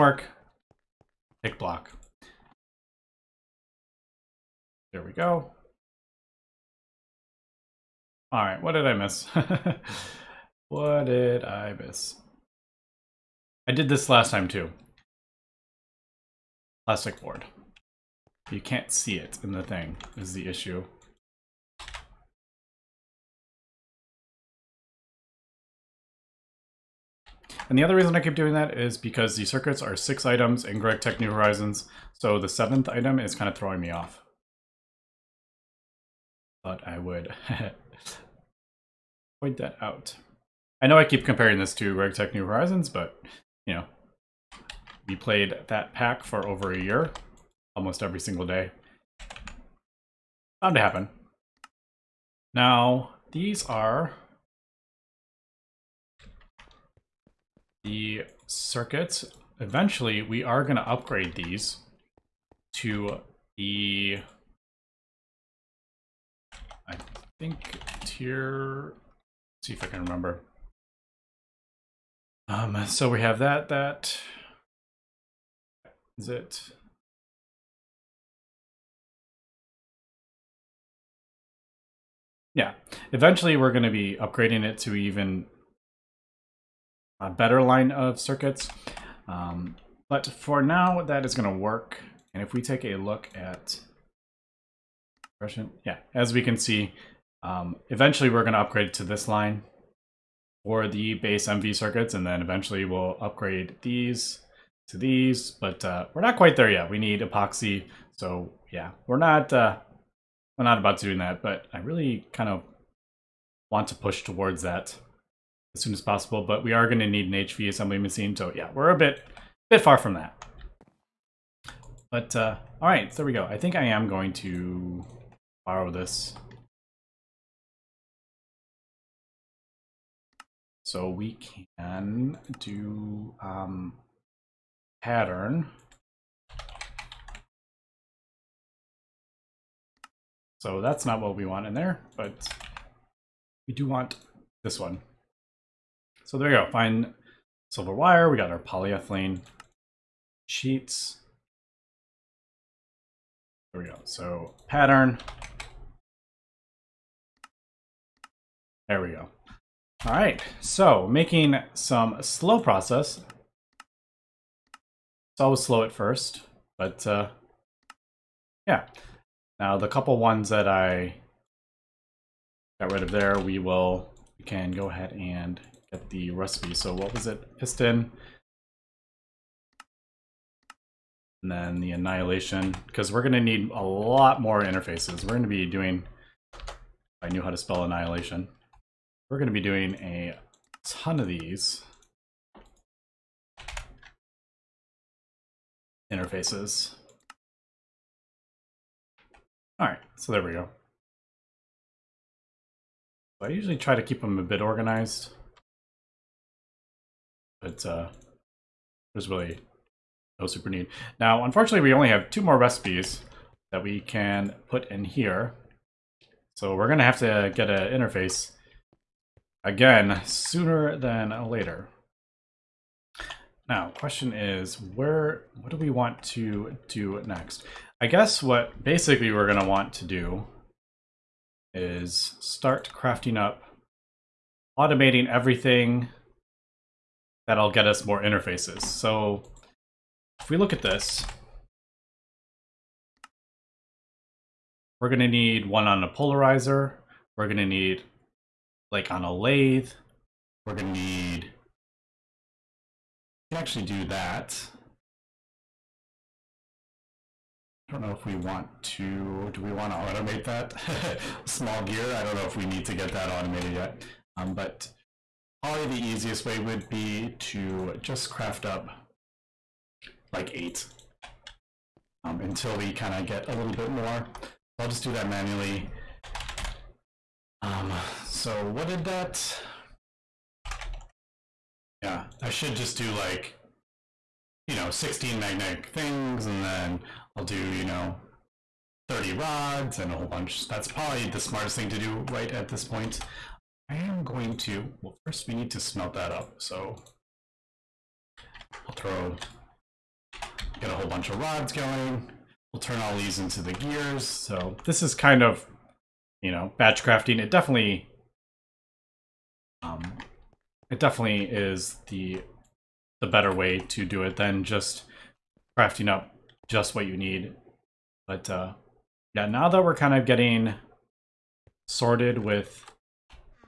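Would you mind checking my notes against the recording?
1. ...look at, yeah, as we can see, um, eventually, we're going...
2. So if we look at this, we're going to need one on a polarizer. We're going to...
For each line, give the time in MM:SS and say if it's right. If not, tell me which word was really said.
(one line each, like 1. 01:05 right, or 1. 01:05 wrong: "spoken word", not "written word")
1. 01:32 right
2. 03:58 right.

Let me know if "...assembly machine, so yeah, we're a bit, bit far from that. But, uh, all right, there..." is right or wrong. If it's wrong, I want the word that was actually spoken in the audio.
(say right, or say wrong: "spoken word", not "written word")
right.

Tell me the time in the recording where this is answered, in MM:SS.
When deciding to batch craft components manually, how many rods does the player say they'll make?
04:49.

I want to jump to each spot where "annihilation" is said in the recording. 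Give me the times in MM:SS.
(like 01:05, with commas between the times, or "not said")
03:01, 03:07.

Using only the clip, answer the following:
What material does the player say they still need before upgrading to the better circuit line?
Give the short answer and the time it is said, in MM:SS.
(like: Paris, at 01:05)
epoxy, at 01:47.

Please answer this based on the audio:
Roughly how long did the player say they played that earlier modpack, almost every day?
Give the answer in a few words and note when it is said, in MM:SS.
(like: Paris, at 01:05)
over a year, at 00:46.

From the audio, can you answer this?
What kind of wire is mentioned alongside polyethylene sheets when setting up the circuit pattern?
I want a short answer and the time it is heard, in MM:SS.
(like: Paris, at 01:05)
fine silver wire, at 02:26.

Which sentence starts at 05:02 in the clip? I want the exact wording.
We'll turn all these into the gears.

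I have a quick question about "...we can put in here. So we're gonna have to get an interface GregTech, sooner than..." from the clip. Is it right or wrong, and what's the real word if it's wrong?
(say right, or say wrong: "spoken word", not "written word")
wrong: "Again", not "GregTech".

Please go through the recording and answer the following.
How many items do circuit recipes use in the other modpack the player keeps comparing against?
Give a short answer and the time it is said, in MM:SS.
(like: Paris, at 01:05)
6, at 00:29.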